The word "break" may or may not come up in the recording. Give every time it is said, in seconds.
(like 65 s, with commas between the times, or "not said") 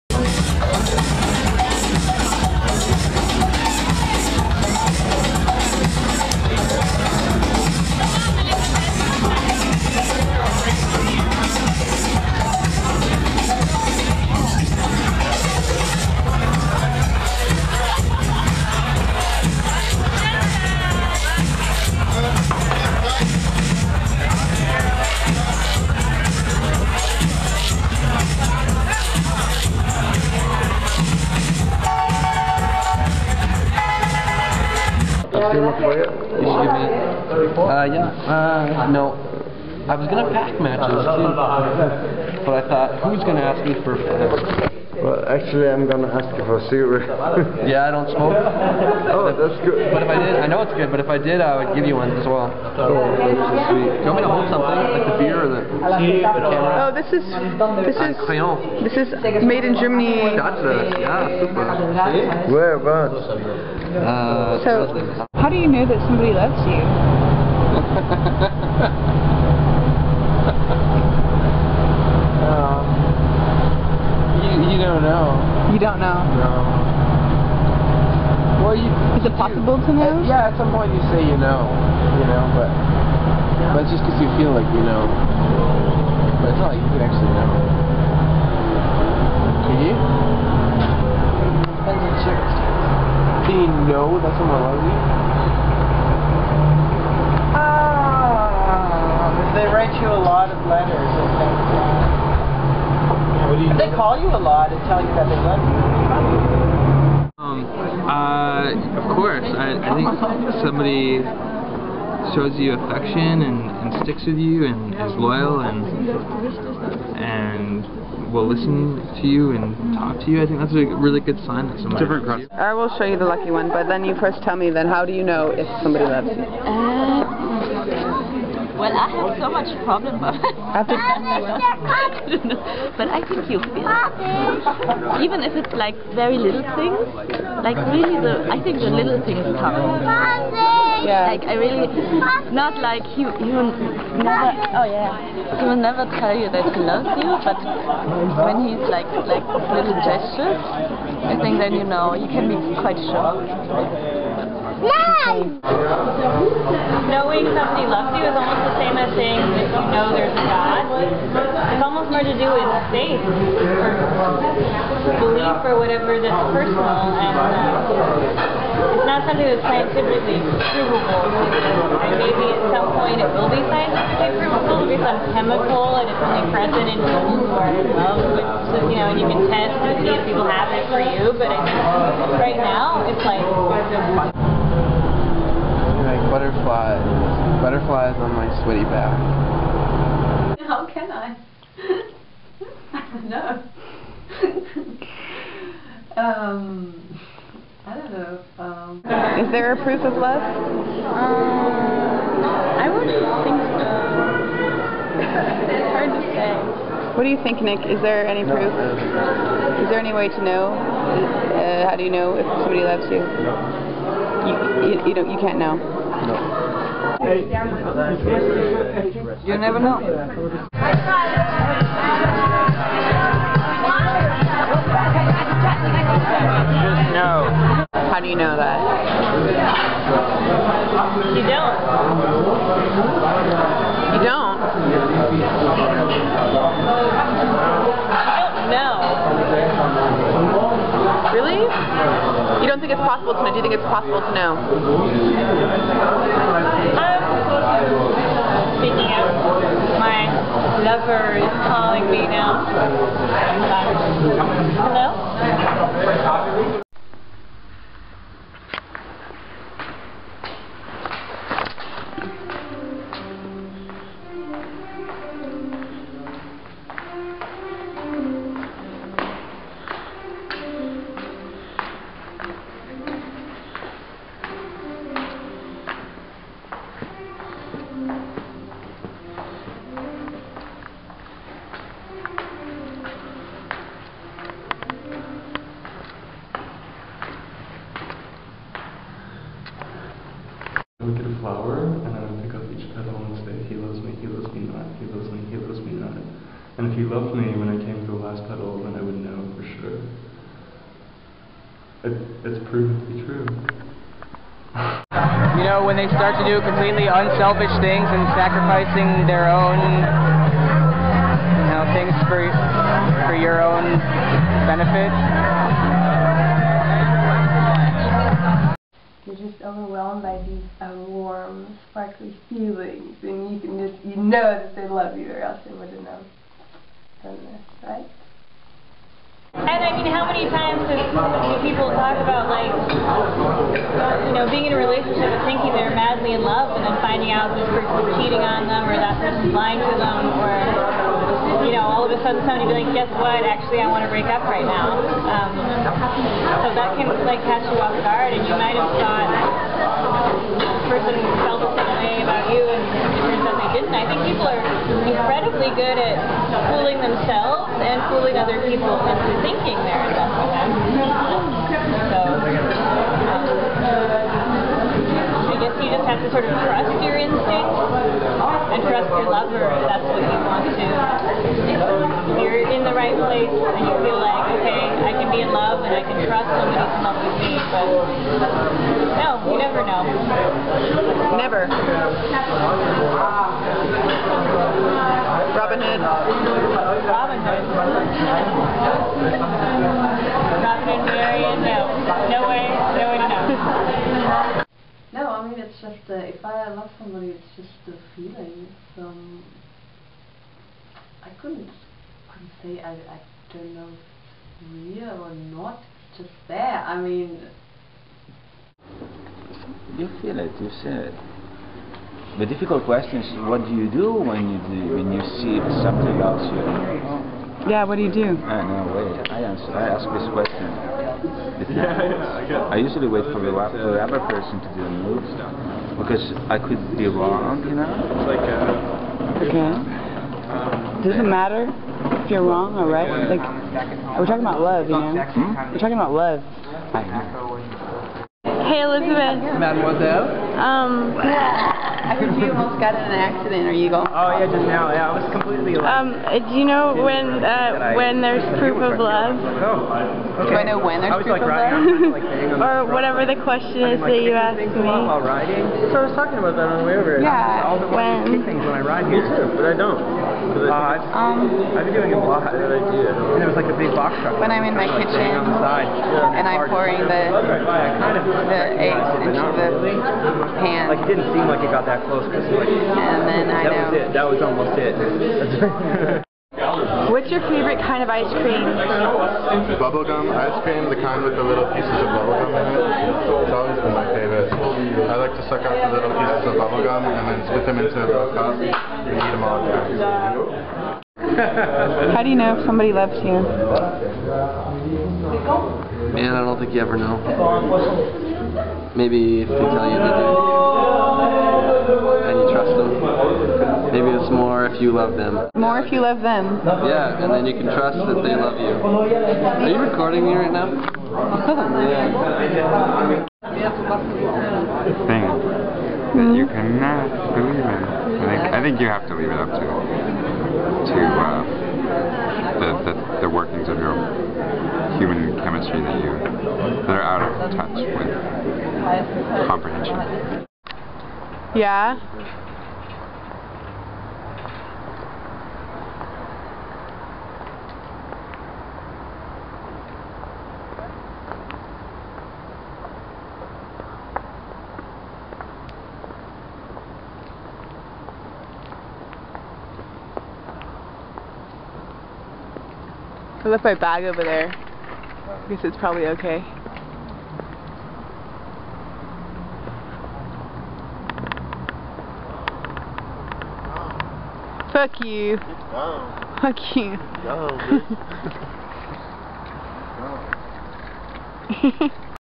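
344 s.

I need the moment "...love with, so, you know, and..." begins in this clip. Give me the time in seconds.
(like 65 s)
177 s.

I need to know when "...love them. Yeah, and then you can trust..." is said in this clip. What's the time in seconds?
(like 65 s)
505 s.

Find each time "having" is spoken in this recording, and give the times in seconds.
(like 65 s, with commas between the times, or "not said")
not said.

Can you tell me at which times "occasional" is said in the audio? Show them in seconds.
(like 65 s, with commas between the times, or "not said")
not said.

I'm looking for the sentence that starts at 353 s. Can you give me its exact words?
I think people are incredibly good at fooling themselves and fooling other people into thinking they're in love with them.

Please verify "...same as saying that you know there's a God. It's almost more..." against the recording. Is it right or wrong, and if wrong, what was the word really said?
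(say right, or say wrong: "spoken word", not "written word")
right.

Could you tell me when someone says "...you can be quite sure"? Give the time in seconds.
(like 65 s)
152 s.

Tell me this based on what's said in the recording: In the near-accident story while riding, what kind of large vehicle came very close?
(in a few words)
box truck.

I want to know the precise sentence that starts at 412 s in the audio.
The difficult question is what do you do when you do, when you see something else you Yeah, what do you do?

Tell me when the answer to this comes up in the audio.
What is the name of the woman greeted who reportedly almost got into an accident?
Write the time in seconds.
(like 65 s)
438 s.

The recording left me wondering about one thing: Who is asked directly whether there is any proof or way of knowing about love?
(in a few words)
Nick.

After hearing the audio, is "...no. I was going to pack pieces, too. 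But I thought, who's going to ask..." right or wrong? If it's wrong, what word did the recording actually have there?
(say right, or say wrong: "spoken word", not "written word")
wrong: "matches", not "pieces".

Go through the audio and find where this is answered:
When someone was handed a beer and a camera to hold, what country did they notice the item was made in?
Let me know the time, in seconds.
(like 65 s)
59 s.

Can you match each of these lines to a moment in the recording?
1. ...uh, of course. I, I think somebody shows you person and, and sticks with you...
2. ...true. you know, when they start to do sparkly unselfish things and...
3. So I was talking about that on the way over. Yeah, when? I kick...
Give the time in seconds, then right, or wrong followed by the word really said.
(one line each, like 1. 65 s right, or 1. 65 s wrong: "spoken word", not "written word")
1. 108 s wrong: "affection", not "person"
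2. 303 s wrong: "completely", not "sparkly"
3. 455 s right.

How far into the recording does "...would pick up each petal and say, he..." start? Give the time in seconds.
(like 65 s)
292 s.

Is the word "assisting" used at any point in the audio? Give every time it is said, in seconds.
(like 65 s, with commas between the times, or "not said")
not said.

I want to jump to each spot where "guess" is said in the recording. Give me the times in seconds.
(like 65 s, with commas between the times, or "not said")
342 s, 365 s, 555 s.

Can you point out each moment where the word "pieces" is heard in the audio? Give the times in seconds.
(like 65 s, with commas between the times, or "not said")
481 s, 486 s.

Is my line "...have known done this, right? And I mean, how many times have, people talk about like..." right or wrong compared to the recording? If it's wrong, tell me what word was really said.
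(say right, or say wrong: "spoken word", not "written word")
right.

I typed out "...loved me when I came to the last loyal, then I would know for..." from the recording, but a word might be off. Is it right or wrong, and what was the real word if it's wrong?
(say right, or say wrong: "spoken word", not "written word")
wrong: "petal", not "loyal".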